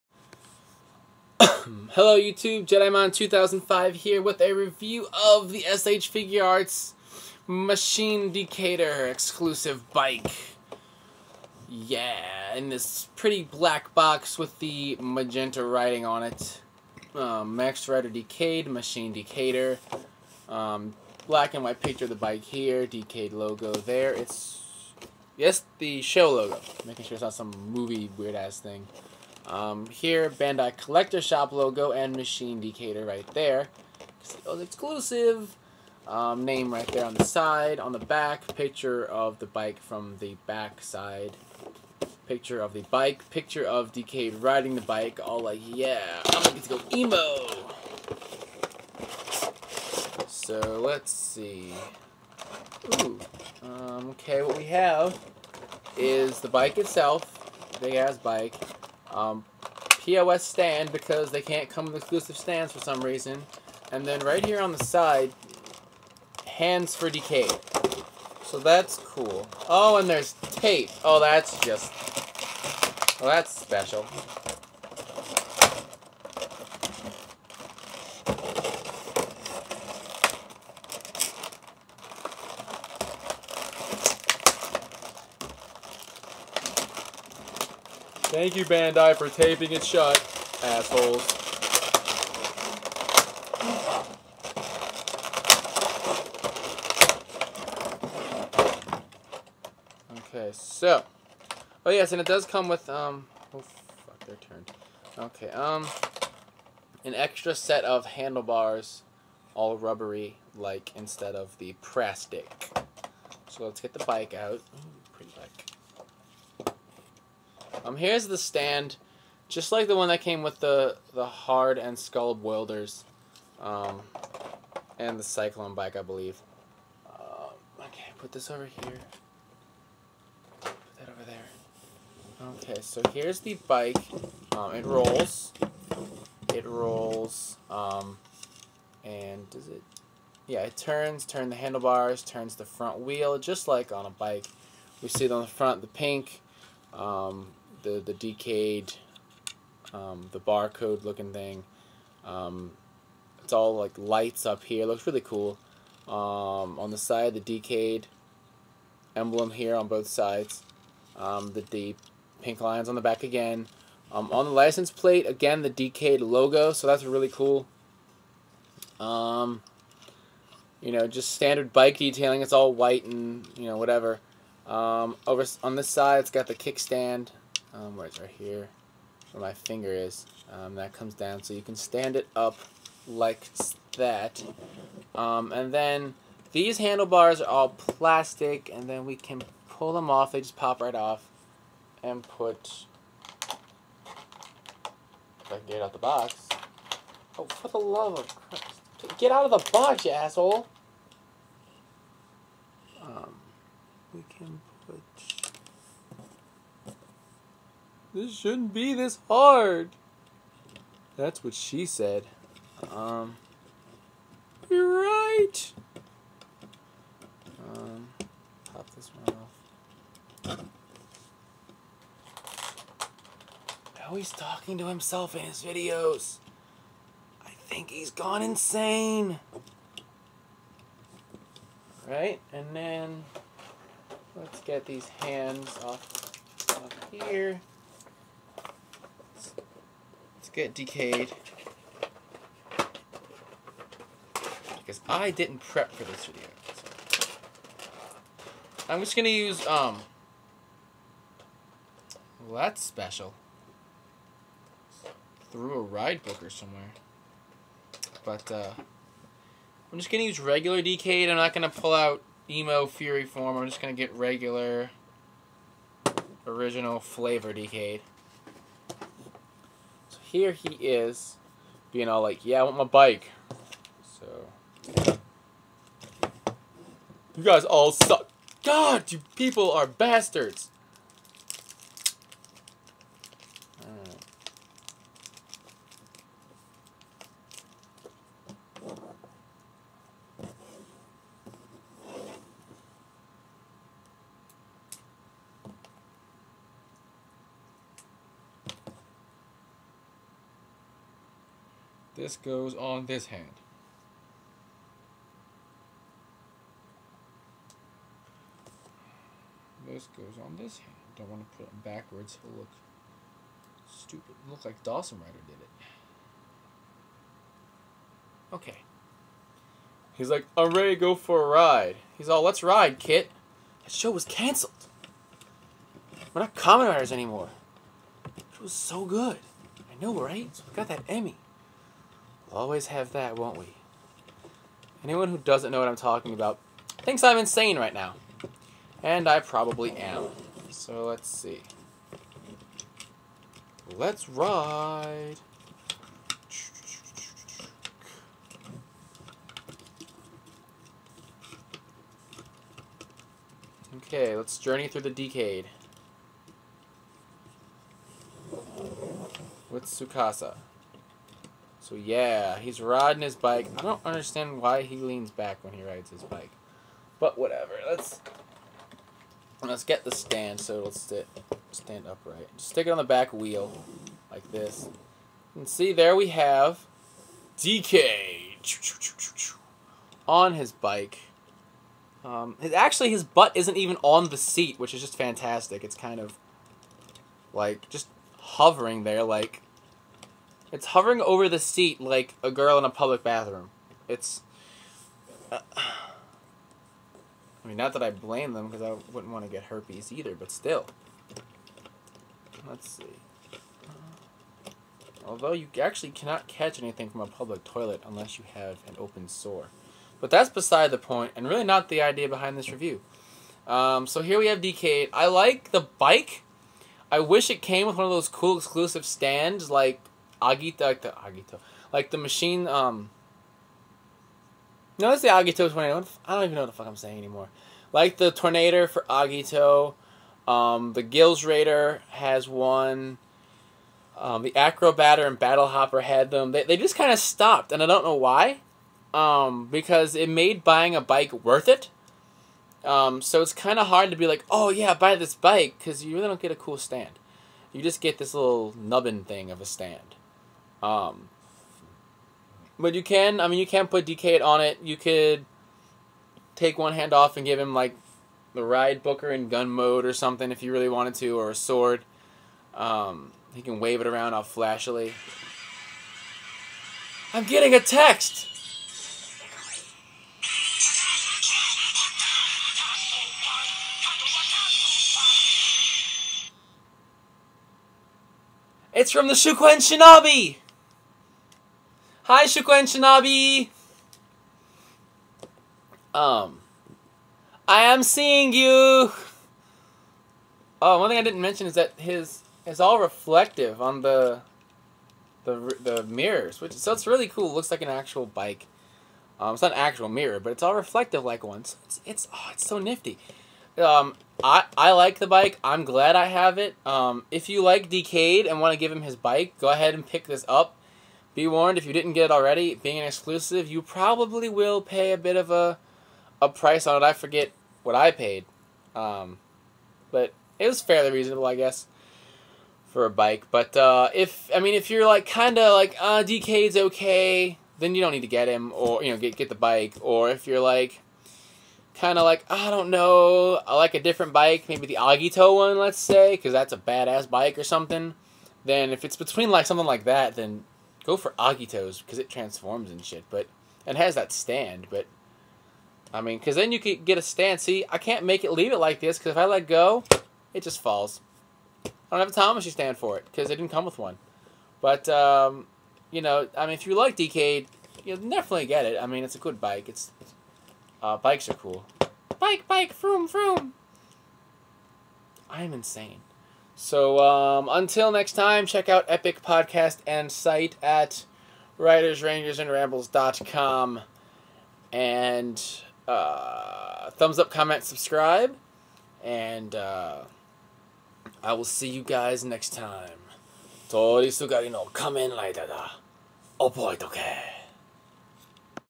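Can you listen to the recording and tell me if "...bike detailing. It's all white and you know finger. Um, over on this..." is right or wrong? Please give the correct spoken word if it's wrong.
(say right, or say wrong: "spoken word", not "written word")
wrong: "whatever", not "finger".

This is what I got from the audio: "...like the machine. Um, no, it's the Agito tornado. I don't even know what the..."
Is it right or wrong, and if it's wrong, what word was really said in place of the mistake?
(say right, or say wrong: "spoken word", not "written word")
right.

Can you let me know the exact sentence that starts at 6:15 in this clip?
And see there we have DK on his bike.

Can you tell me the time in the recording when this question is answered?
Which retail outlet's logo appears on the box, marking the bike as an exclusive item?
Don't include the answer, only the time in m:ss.
0:30.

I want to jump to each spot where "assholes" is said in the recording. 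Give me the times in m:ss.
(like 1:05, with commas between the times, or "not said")
1:30, 3:20.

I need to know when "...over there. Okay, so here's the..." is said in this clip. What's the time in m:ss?
2:11.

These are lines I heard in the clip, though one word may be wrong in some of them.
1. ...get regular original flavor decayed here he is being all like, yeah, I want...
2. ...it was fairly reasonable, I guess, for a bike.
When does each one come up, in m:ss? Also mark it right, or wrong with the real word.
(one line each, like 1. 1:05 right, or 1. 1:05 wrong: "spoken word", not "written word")
1. 4:24 right
2. 8:40 right.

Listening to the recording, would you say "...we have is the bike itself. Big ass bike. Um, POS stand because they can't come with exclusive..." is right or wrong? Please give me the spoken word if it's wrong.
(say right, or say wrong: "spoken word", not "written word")
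right.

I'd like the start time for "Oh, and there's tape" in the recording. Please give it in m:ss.
1:09.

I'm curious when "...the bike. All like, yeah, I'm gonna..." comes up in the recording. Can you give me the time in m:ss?
0:44.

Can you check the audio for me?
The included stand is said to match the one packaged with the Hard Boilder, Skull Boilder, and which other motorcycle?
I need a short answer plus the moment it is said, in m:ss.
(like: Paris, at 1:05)
Cyclone, at 2:05.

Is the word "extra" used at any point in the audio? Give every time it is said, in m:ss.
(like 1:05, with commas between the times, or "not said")
1:47.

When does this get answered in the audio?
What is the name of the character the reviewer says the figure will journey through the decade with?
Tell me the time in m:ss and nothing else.
5:59.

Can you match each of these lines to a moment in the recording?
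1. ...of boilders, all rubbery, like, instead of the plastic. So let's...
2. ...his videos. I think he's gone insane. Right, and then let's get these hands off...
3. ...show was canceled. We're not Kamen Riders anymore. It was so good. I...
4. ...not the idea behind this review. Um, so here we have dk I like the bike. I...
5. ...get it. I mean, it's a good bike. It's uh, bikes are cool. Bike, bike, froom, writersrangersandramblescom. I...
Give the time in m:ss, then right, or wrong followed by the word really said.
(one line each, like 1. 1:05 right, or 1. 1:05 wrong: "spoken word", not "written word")
1. 1:47 wrong: "handlebars", not "boilders"
2. 3:45 right
3. 5:23 right
4. 6:51 right
5. 9:18 wrong: "froom", not "writersrangersandramblescom".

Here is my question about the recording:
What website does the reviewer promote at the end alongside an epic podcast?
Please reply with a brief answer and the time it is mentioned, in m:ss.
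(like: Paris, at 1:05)
writersrangersandrambles.com, at 9:31.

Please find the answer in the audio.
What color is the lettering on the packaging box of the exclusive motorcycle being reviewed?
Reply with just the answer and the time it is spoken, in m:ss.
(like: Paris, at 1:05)
Magenta, at 0:14.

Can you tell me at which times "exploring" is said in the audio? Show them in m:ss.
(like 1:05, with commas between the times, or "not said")
not said.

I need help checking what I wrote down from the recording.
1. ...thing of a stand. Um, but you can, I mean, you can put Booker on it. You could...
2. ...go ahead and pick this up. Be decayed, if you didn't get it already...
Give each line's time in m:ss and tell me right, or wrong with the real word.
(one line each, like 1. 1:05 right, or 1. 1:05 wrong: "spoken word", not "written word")
1. 7:29 wrong: "Decade", not "Booker"
2. 8:29 wrong: "warned", not "decayed".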